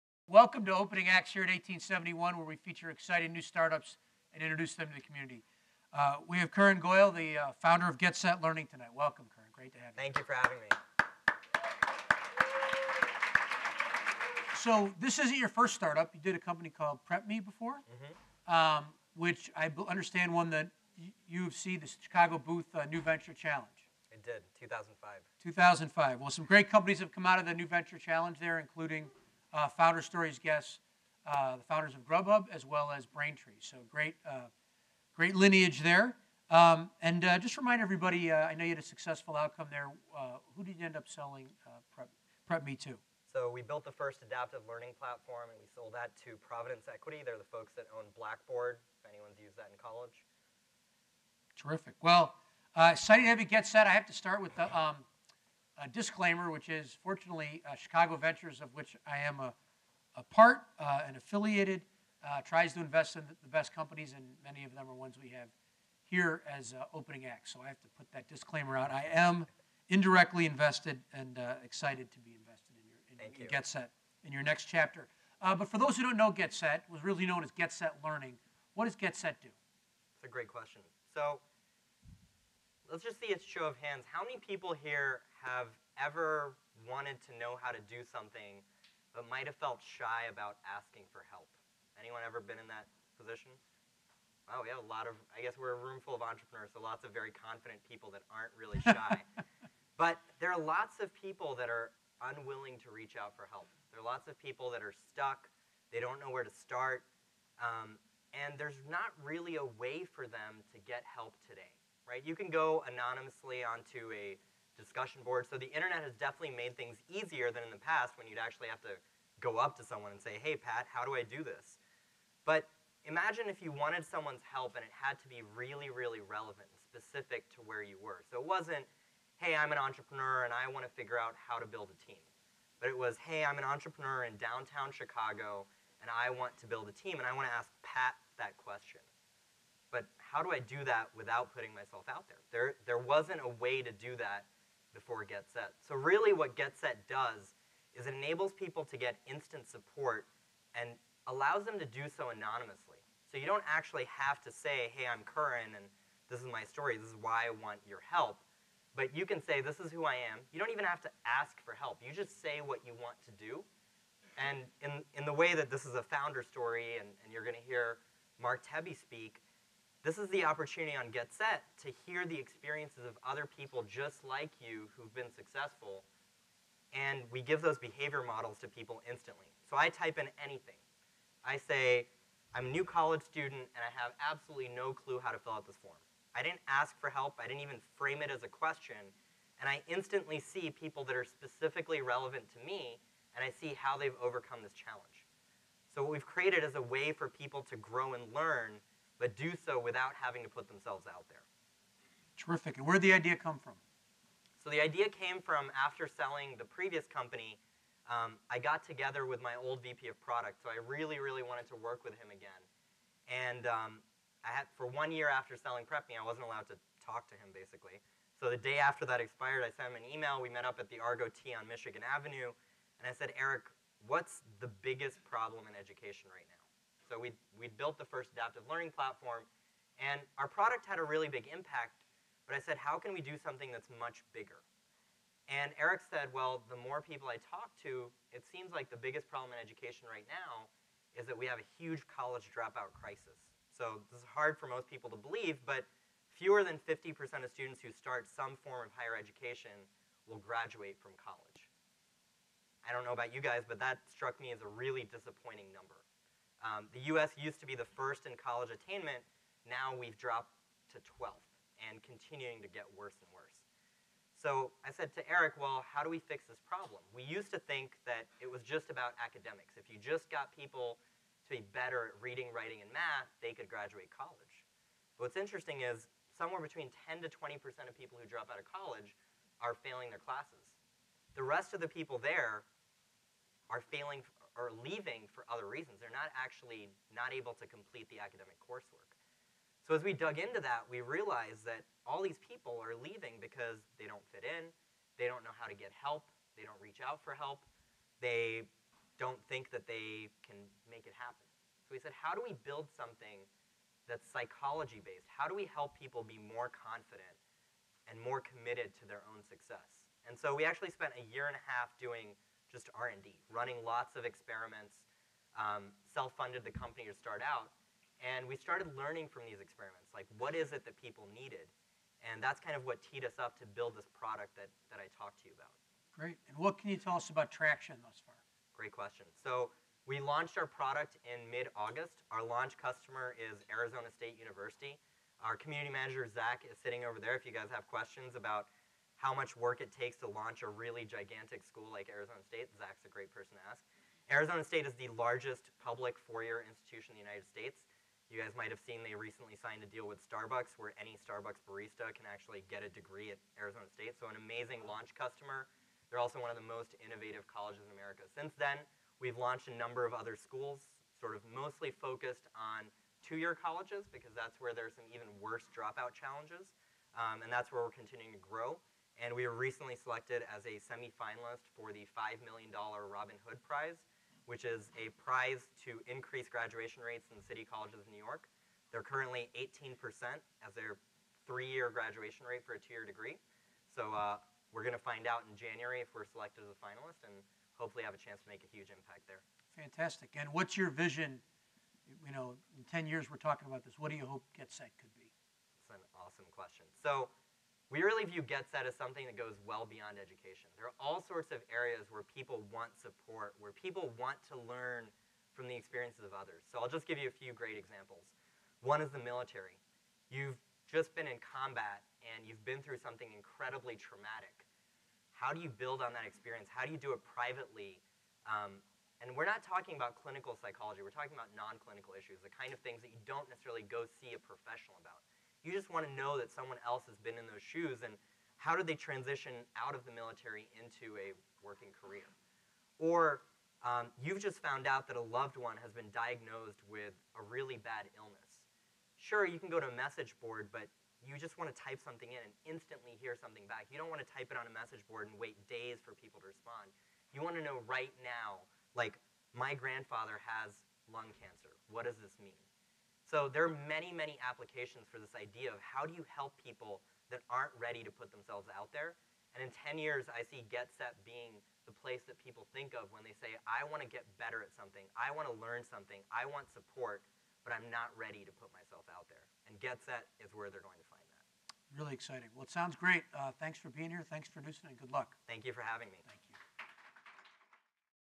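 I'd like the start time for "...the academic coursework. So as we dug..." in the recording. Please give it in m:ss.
4:48.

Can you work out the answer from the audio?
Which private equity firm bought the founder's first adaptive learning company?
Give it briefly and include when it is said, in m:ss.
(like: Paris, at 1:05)
Providence Equity, at 0:46.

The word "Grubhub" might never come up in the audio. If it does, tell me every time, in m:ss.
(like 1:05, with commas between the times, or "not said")
0:32.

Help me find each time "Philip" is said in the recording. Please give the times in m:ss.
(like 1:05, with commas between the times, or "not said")
not said.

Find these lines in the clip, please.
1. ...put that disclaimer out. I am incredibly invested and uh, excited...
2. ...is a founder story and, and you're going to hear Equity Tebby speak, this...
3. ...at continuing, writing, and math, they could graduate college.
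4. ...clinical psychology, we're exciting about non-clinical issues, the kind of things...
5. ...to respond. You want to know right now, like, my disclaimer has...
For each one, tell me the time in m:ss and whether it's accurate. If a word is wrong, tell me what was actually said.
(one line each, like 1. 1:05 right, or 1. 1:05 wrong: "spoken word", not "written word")
1. 1:07 wrong: "indirectly", not "incredibly"
2. 2:45 wrong: "Mark", not "Equity"
3. 4:32 wrong: "reading", not "continuing"
4. 7:00 wrong: "talking", not "exciting"
5. 7:26 wrong: "grandfather", not "disclaimer".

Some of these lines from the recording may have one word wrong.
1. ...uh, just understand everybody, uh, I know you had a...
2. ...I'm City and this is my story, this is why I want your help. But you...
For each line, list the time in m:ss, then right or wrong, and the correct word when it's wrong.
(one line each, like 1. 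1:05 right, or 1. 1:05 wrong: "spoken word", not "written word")
1. 0:37 wrong: "remind", not "understand"
2. 2:35 wrong: "Karan", not "City".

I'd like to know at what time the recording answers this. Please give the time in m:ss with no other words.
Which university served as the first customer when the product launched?
5:33.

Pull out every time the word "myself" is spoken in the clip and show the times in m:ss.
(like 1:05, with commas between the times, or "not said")
2:21, 7:48.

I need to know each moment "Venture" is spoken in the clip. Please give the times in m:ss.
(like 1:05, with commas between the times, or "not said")
0:23, 0:27, 0:58.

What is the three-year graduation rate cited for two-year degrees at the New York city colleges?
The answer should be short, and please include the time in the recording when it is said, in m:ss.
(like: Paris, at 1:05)
18%, at 6:19.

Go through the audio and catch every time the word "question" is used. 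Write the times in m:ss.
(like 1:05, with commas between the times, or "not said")
1:20, 2:18, 3:08, 5:28, 5:37, 6:36.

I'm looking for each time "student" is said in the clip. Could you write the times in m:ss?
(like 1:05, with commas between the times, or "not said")
3:03, 4:07.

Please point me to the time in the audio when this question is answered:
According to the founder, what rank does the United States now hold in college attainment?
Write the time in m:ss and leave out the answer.
4:21.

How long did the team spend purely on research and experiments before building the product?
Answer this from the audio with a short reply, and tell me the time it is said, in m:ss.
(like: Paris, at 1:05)
a year and a half, at 5:11.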